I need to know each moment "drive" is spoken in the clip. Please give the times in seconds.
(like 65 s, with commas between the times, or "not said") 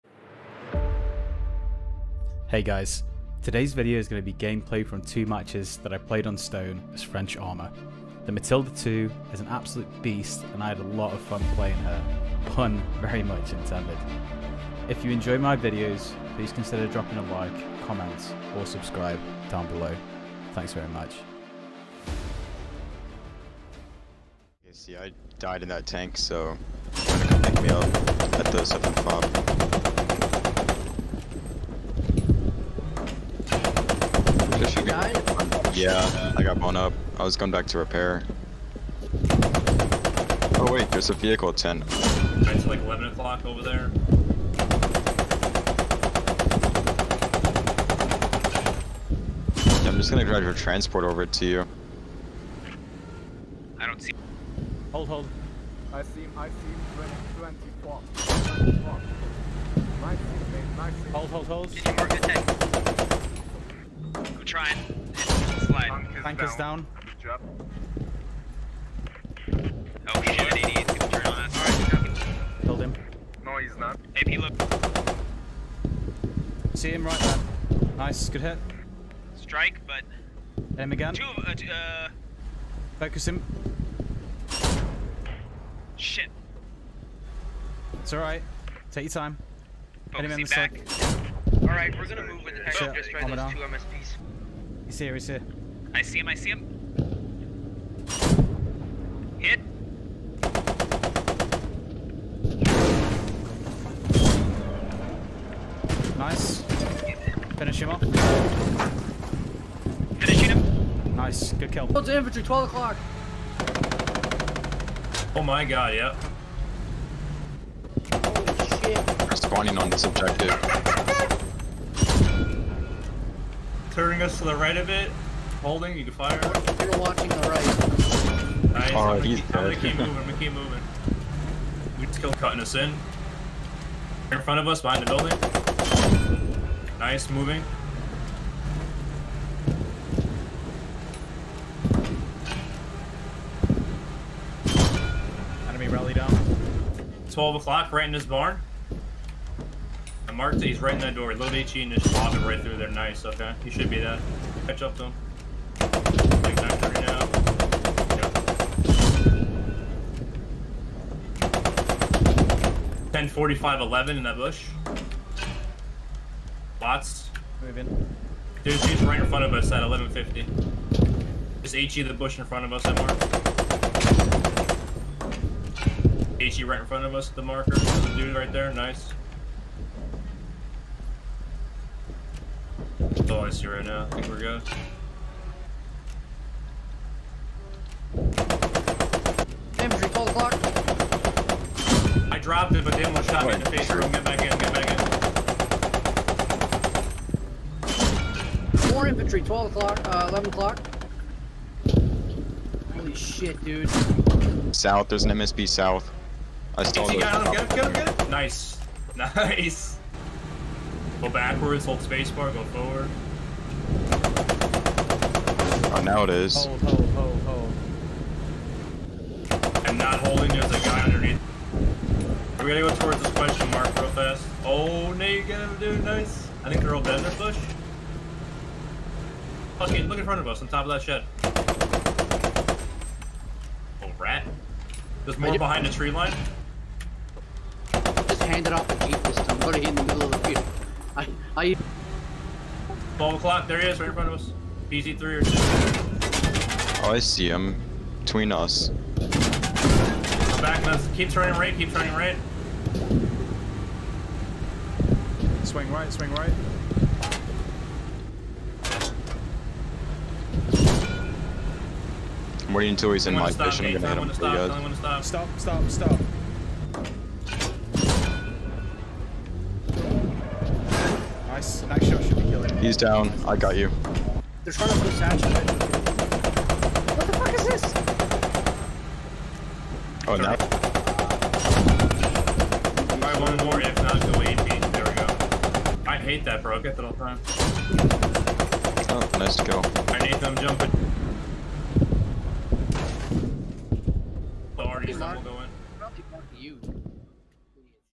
50 s.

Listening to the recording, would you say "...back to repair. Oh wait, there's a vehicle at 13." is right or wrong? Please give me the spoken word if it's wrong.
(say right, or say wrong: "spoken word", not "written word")
wrong: "10", not "13".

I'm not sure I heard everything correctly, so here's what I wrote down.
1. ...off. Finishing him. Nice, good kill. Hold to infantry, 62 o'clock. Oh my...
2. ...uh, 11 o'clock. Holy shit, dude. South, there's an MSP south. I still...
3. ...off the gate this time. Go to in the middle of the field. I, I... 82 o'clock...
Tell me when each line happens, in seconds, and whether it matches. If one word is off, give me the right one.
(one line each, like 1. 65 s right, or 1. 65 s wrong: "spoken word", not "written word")
1. 107 s wrong: "12", not "62"
2. 200 s right
3. 238 s wrong: "12", not "82".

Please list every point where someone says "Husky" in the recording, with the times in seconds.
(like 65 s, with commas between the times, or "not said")
229 s.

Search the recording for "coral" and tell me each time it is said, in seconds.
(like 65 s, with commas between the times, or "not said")
not said.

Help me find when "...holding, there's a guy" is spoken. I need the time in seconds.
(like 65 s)
220 s.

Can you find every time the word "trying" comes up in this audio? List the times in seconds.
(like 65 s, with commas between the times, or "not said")
64 s, 274 s.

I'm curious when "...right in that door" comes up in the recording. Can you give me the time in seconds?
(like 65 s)
150 s.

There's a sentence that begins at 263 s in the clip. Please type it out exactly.
I'm gonna hit him for you Stop.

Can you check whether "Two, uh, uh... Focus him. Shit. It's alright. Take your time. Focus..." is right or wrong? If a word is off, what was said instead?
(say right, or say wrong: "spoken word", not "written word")
right.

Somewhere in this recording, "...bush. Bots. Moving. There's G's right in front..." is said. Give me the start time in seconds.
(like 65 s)
164 s.